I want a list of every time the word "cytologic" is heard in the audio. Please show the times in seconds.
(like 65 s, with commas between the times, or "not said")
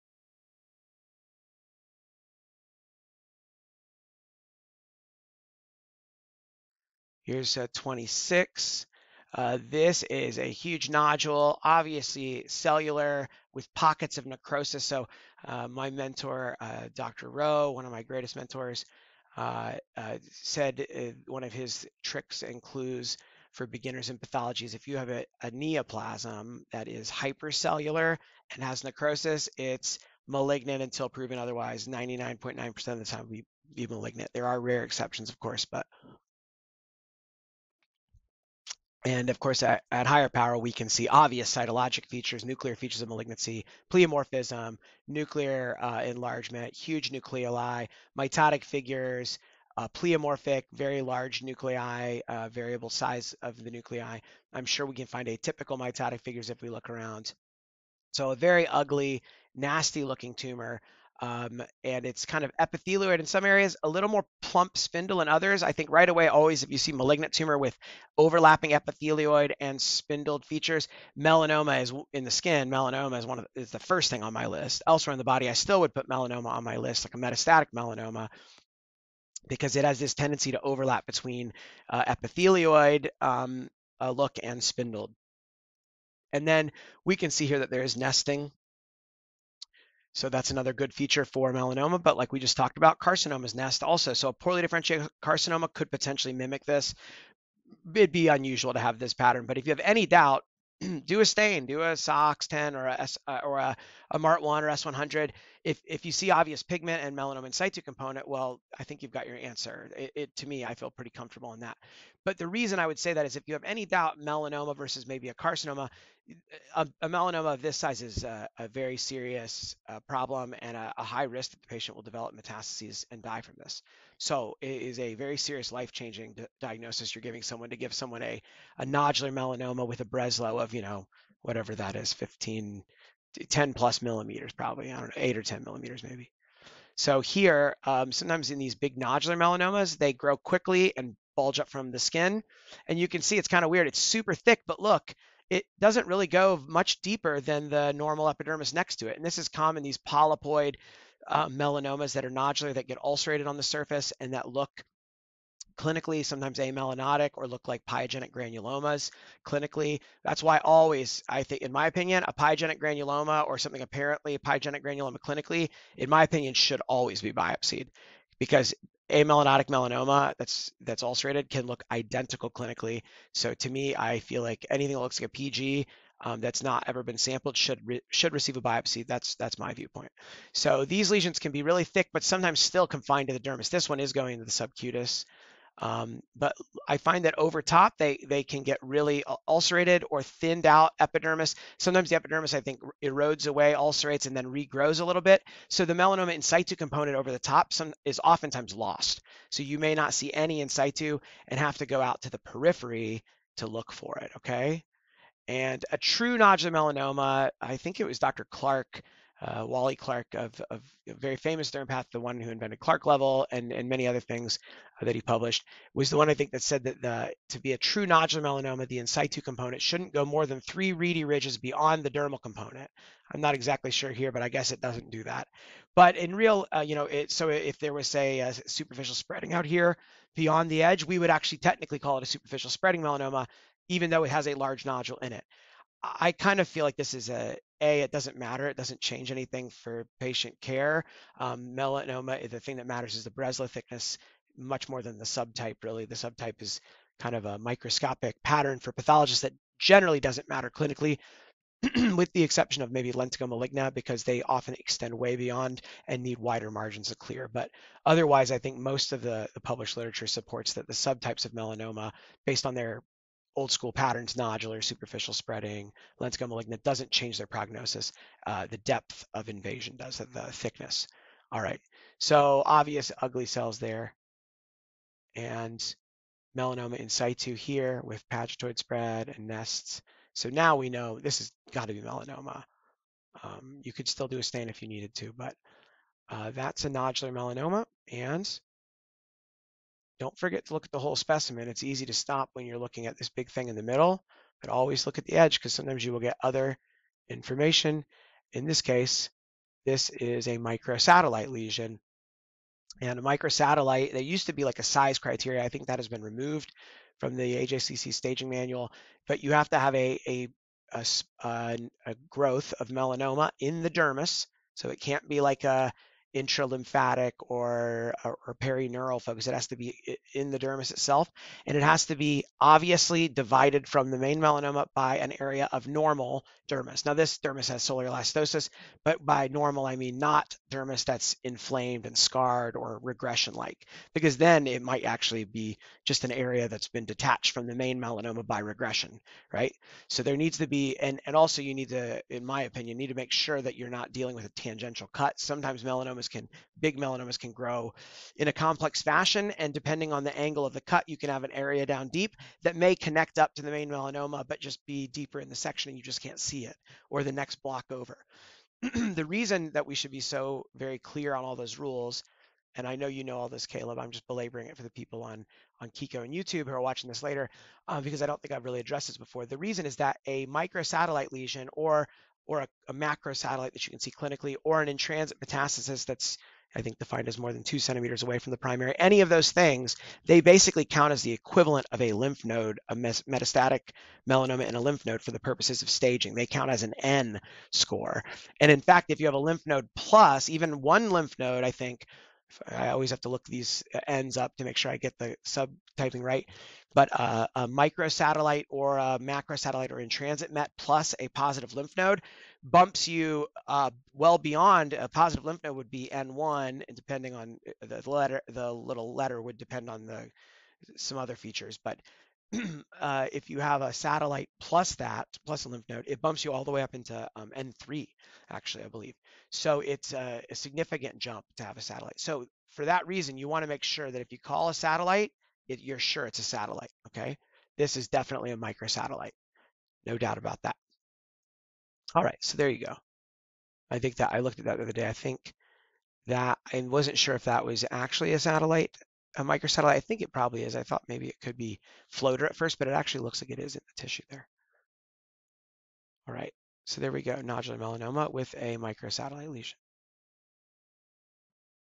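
41 s.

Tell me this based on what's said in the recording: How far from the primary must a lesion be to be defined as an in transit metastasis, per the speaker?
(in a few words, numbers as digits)
more than 2 centimeters.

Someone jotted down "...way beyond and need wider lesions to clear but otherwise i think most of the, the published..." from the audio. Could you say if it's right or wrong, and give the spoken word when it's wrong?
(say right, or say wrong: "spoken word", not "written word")
wrong: "margins", not "lesions".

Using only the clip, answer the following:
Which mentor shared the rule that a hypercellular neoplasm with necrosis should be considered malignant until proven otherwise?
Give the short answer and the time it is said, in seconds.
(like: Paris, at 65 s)
Dr. Rowe, at 16 s.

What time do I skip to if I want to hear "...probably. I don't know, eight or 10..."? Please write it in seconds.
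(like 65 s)
134 s.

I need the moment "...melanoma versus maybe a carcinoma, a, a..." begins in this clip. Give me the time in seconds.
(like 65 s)
114 s.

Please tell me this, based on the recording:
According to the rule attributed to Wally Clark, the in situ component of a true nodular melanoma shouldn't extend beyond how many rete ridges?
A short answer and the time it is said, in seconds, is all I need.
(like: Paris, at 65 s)
3, at 220 s.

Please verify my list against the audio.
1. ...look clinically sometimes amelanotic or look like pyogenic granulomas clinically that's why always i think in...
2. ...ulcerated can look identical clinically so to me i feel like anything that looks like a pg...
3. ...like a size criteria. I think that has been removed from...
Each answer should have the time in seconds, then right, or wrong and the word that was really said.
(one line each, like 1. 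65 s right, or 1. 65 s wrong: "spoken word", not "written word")
1. 154 s right
2. 171 s right
3. 304 s right.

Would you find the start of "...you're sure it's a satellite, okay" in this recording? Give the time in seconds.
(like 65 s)
425 s.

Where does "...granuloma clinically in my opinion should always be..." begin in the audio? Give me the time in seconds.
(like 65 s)
164 s.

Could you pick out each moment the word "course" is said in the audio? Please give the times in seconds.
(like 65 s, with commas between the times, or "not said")
35 s, 39 s.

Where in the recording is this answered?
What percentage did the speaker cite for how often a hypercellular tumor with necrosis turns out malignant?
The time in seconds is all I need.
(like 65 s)
31 s.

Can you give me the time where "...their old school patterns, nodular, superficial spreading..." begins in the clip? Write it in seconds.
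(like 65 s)
262 s.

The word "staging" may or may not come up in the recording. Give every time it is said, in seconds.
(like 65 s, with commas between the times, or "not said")
308 s, 385 s.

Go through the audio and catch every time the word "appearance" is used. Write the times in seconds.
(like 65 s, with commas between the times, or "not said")
not said.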